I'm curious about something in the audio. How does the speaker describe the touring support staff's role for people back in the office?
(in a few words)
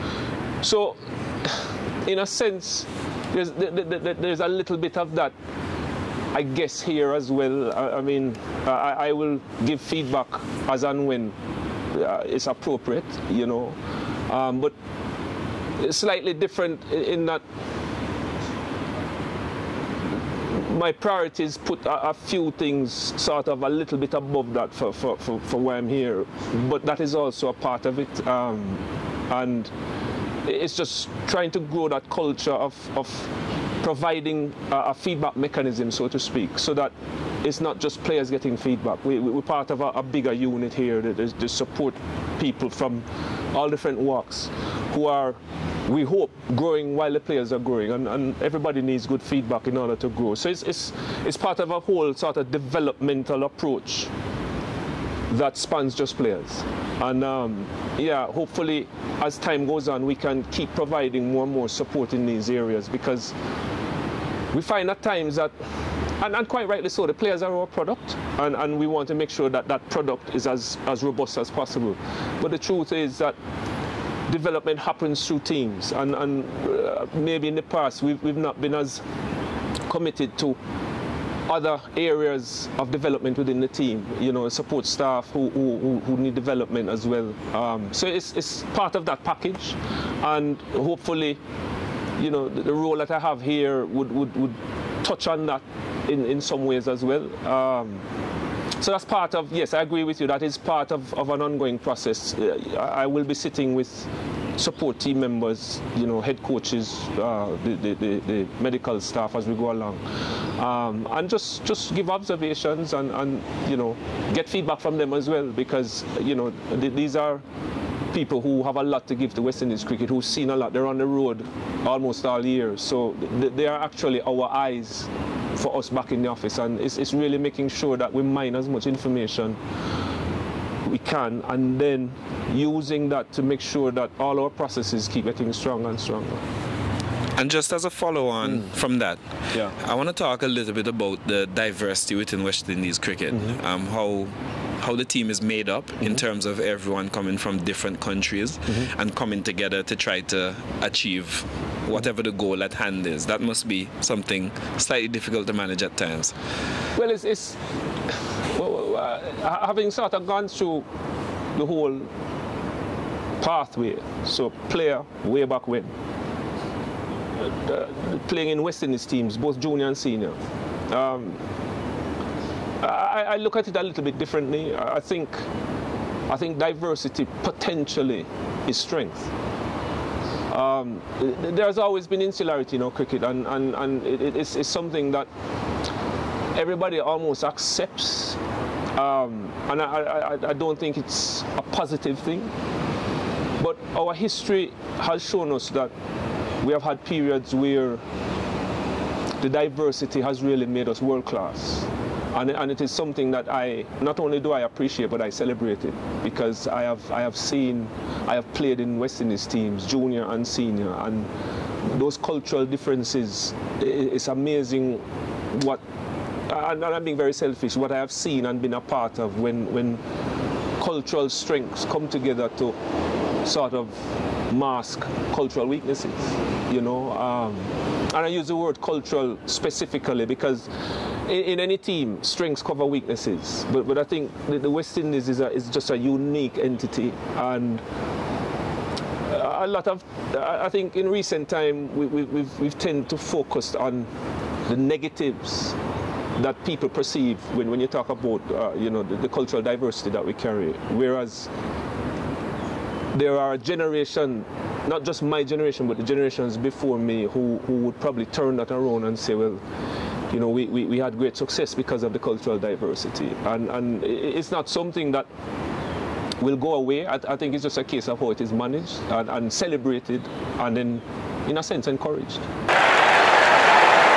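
our eyes.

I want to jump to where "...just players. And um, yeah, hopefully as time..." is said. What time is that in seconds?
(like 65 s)
55 s.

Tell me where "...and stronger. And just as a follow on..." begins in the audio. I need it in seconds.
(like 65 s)
135 s.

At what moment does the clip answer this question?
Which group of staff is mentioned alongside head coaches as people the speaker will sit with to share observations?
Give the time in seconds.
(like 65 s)
108 s.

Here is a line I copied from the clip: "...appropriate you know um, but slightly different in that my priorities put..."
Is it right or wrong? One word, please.
right.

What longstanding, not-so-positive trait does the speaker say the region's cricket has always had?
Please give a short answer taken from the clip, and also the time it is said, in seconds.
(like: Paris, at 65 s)
insularity, at 182 s.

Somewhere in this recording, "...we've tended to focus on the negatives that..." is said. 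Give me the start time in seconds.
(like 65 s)
242 s.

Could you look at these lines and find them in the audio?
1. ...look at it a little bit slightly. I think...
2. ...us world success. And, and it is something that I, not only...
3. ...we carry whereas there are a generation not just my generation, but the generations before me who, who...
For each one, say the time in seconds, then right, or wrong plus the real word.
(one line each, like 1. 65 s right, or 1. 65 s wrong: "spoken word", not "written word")
1. 173 s wrong: "differently", not "slightly"
2. 200 s wrong: "class", not "success"
3. 250 s right.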